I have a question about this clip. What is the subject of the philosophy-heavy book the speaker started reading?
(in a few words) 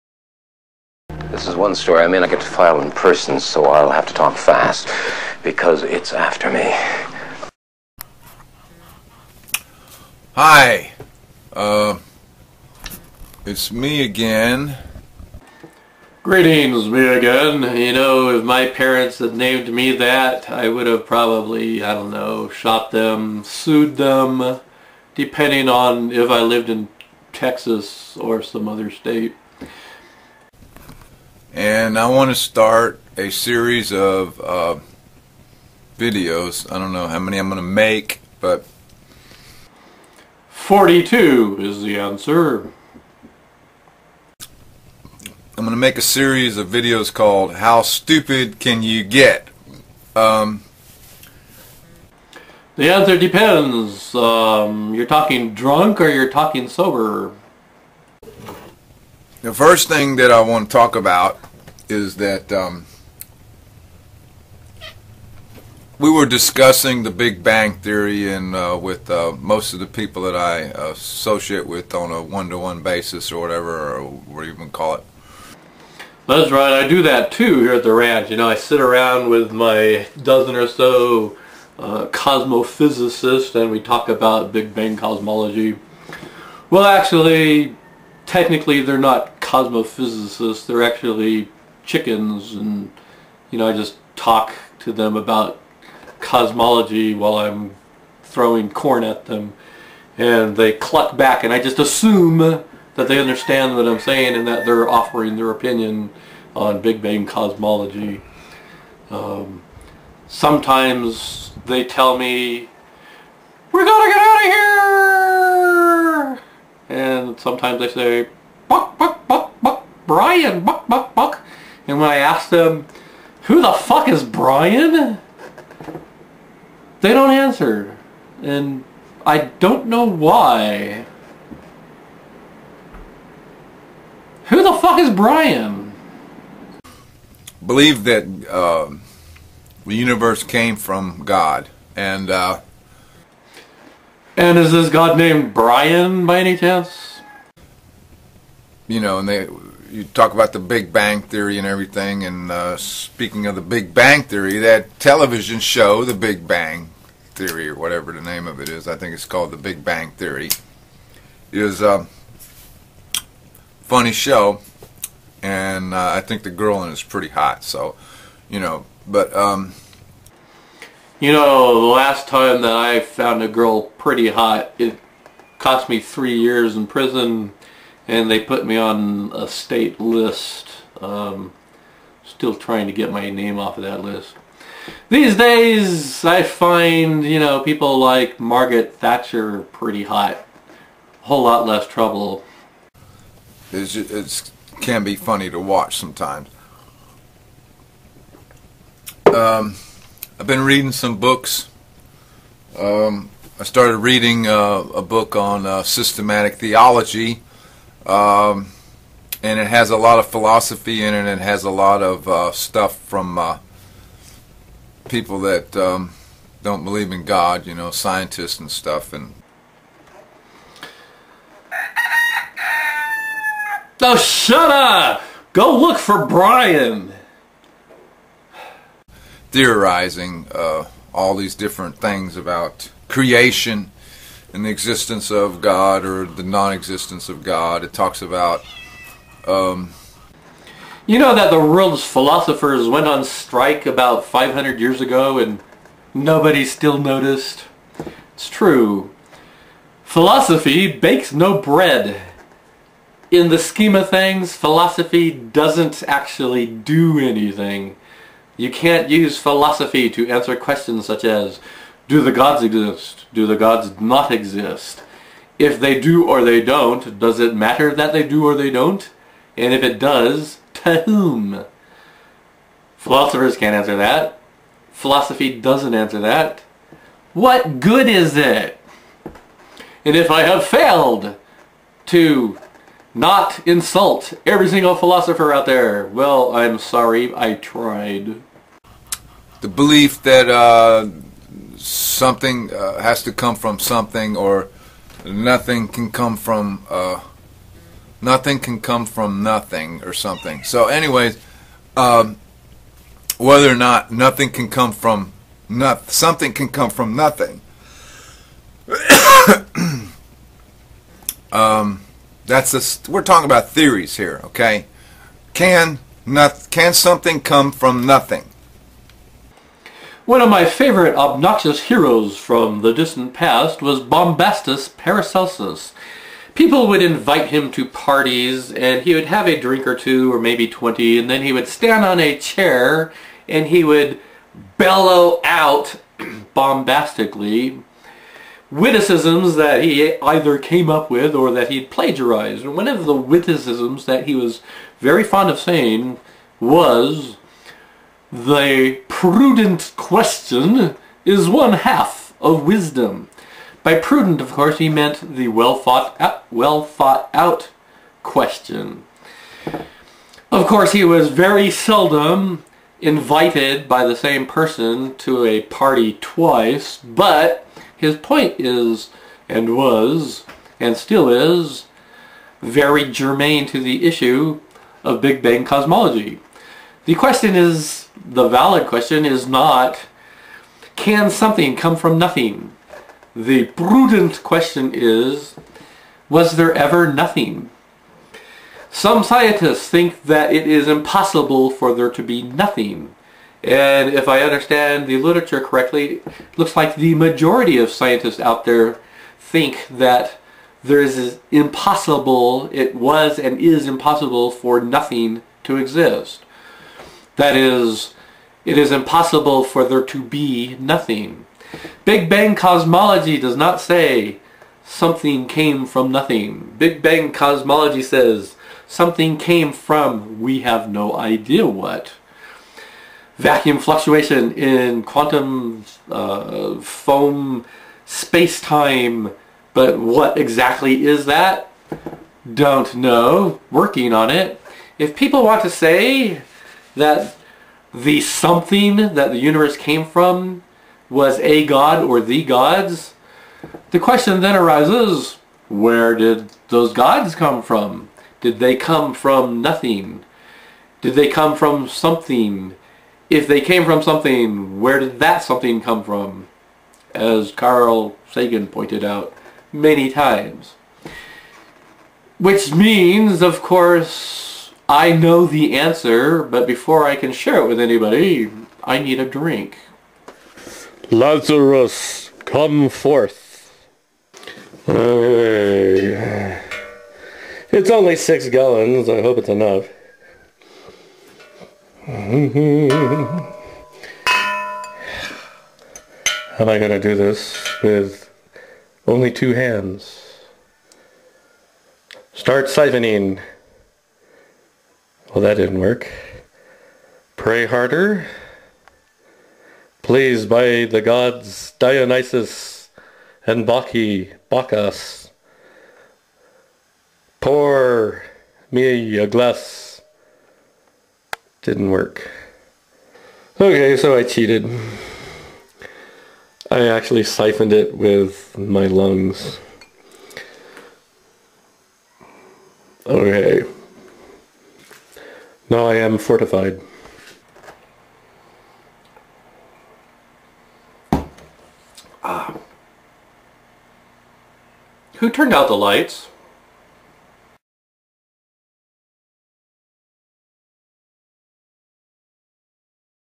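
Systematic theology.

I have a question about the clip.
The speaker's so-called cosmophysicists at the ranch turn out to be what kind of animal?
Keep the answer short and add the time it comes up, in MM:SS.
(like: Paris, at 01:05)
Chickens, at 01:31.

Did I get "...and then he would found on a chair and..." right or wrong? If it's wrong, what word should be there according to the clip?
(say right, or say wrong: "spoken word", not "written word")
wrong: "stand", not "found".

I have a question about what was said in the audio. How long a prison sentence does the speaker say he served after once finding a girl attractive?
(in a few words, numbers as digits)
Three years.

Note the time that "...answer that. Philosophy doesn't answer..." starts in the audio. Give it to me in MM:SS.
04:33.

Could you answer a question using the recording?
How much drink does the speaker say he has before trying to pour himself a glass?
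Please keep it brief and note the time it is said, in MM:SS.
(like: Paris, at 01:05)
6 gallons, at 07:58.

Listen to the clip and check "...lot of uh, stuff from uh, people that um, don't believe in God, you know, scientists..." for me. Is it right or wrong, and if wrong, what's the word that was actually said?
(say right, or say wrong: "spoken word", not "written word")
right.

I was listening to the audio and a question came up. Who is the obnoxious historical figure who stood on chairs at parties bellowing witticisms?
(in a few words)
Bombastus Paracelsus.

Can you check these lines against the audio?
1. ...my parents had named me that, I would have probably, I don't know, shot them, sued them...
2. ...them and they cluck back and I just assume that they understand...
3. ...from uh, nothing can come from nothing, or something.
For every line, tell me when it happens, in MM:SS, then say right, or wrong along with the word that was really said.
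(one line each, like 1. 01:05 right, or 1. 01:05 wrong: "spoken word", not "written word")
1. 00:18 right
2. 01:39 right
3. 04:56 right.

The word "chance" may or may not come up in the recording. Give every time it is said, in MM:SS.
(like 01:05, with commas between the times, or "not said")
02:26.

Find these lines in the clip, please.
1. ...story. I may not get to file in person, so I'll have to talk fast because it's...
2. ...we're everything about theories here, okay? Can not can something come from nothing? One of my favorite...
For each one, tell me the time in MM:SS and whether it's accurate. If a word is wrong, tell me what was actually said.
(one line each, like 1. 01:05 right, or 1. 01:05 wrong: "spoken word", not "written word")
1. 00:01 right
2. 05:13 wrong: "talking", not "everything".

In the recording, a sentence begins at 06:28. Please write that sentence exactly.
Some scientists think that it is impossible for there to be nothing.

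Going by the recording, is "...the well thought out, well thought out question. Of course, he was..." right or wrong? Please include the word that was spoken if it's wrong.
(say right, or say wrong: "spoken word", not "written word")
right.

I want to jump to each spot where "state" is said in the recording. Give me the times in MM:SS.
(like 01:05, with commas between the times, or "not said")
00:28, 02:59.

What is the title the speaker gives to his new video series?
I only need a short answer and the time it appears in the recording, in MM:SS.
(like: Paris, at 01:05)
How Stupid Can You Get?, at 00:47.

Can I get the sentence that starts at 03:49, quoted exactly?
Theorizing uh, all these different things about creation in the existence of God or the non existence of God.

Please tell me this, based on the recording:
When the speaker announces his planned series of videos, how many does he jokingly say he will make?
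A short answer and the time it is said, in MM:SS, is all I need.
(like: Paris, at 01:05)
42, at 00:40.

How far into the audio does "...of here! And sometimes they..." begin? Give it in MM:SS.
01:56.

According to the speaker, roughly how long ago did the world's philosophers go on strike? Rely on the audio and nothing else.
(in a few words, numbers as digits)
500 years.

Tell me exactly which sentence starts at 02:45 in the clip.
And uh, I think the girl in it is pretty hot.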